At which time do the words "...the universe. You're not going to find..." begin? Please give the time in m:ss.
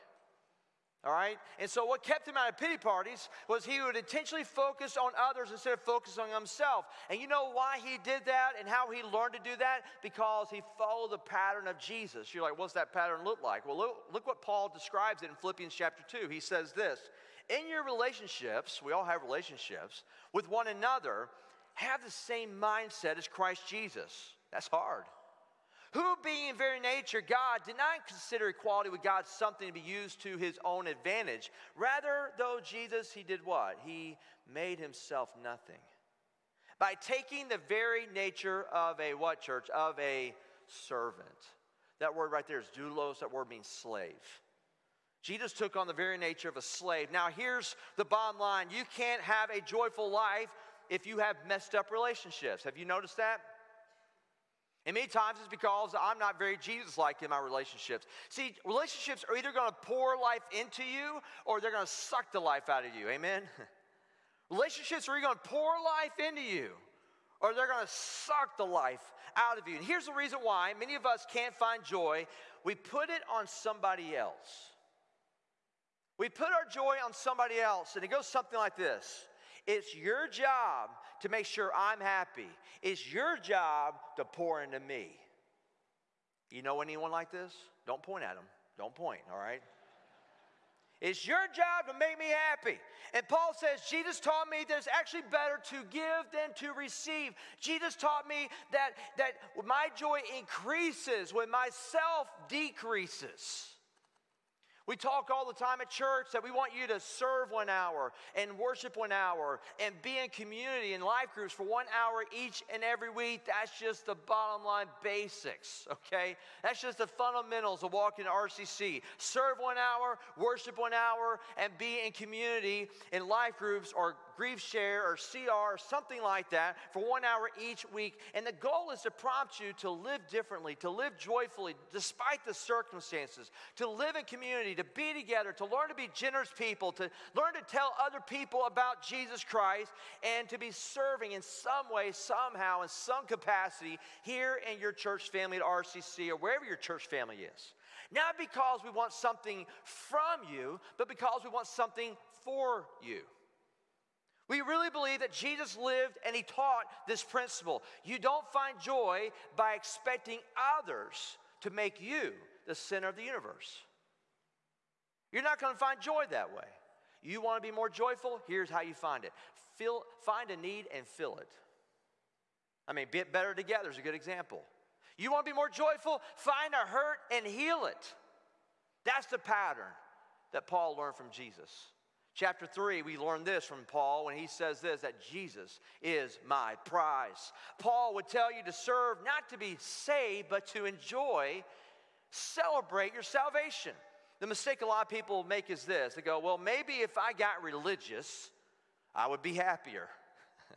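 2:43.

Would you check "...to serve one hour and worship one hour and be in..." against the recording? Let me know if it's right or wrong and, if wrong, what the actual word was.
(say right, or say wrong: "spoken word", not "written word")
right.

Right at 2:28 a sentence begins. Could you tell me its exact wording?
Not because we want something from you, but because we want something for you.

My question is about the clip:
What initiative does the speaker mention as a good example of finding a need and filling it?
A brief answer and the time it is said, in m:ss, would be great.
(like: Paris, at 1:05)
Better Together, at 2:53.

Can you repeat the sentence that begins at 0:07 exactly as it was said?
And you know why he did that and how he learned to do that?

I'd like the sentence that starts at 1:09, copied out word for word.
And here's the reason why many of us can't find joy we put it on somebody else.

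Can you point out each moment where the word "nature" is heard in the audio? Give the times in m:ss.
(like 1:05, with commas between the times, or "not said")
0:26, 0:38, 0:46.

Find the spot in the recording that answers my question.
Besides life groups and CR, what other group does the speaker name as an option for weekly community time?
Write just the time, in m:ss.
2:04.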